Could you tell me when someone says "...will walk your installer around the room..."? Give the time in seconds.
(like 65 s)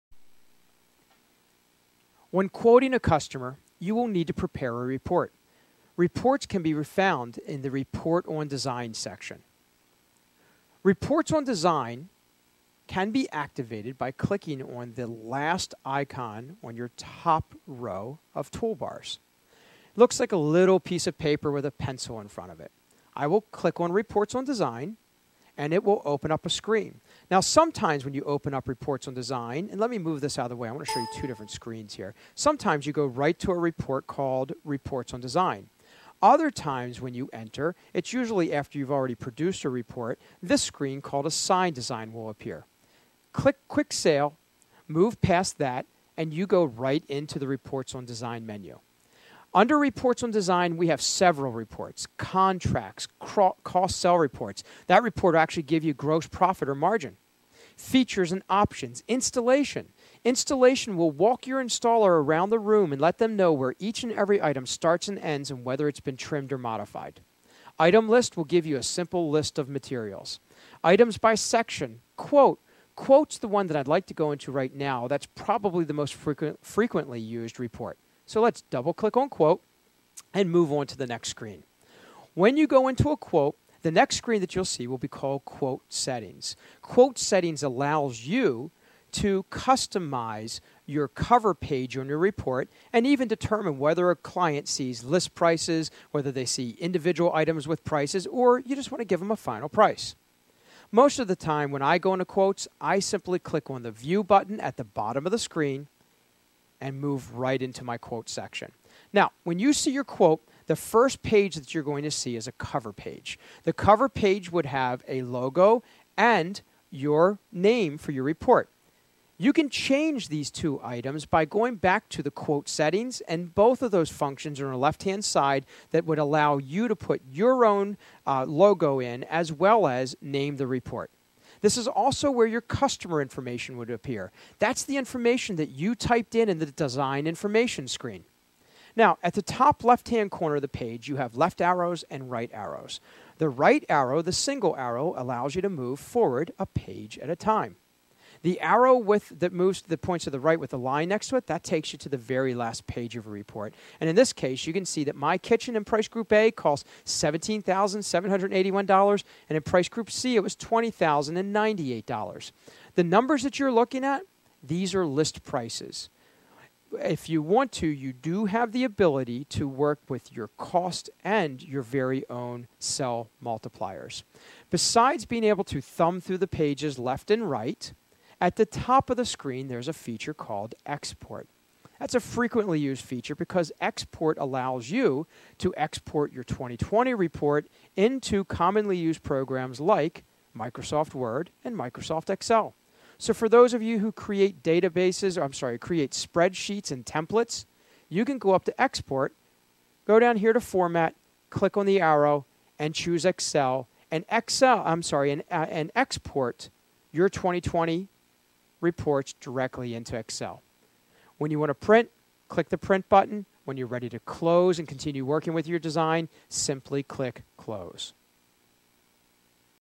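60 s.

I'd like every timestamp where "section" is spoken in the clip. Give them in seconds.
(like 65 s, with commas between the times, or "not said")
8 s, 71 s, 108 s.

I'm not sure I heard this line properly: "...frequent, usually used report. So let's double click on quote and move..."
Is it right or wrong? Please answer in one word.
wrong.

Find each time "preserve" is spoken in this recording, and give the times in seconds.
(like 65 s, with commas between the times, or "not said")
not said.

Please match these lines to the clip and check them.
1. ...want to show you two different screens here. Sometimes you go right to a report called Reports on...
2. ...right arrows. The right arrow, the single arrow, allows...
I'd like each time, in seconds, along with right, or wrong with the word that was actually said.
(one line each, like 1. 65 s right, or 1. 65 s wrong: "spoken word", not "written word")
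1. 30 s right
2. 142 s right.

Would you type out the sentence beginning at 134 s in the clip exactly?
That's the information that you typed in in the design information screen.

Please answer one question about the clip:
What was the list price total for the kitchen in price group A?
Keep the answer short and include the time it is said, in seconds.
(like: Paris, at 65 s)
$17,781, at 157 s.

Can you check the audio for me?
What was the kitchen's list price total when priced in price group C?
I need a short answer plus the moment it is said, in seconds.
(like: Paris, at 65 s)
$20,098, at 160 s.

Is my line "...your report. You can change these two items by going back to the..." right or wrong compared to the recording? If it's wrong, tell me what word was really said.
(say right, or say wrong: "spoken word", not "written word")
right.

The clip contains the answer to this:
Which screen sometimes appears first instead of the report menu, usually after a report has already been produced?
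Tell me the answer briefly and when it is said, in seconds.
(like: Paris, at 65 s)
Assign Design, at 41 s.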